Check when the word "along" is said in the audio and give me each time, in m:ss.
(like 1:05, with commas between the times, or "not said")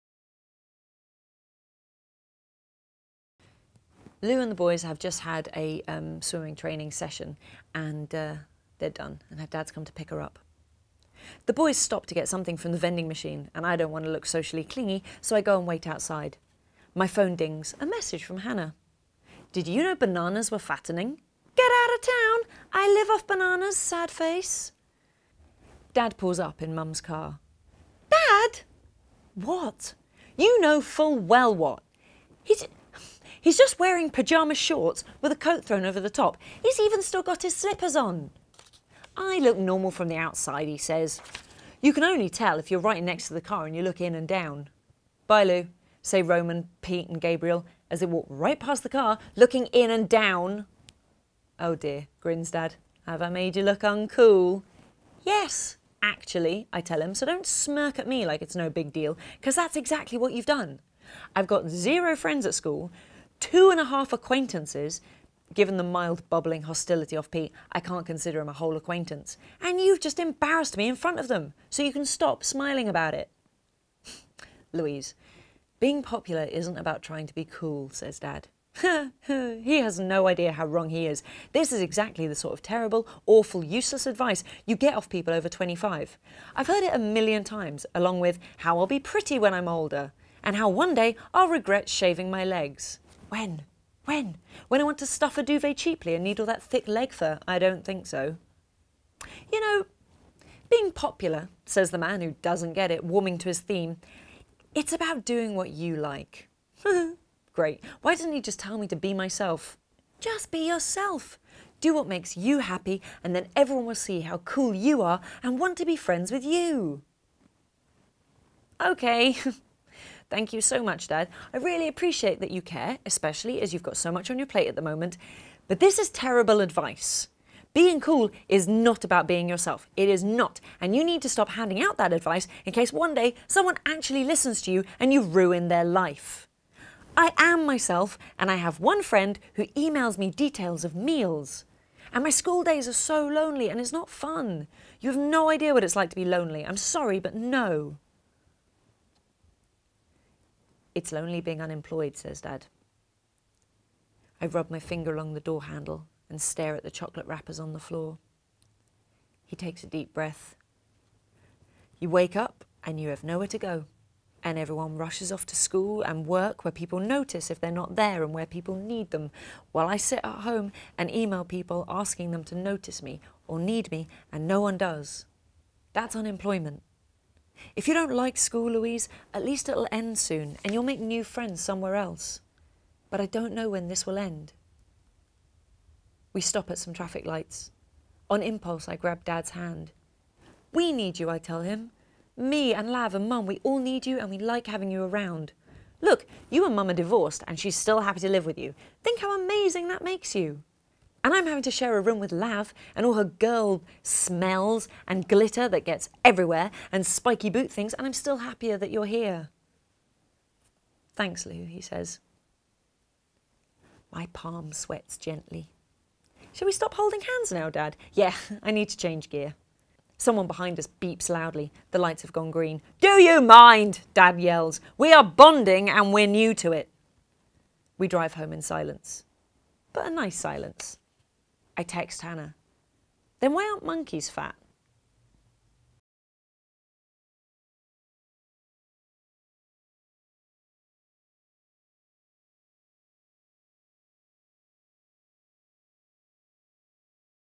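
1:27, 2:35.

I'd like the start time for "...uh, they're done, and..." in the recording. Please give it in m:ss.
0:08.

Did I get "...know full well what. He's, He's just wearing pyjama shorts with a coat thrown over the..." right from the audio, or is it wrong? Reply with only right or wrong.
right.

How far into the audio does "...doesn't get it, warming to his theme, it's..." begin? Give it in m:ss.
1:42.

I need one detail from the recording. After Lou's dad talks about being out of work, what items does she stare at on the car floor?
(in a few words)
chocolate wrappers.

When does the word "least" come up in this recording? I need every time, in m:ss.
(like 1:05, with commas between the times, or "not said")
2:59.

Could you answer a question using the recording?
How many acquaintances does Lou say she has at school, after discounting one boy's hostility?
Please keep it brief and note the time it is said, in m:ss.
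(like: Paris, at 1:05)
2 and a half, at 1:03.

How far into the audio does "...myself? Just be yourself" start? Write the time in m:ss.
1:49.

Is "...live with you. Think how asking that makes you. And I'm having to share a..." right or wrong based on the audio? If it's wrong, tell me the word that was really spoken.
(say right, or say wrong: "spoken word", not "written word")
wrong: "amazing", not "asking".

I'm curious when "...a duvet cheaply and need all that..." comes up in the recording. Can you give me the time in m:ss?
1:35.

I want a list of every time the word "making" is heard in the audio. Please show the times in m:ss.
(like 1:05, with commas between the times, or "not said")
not said.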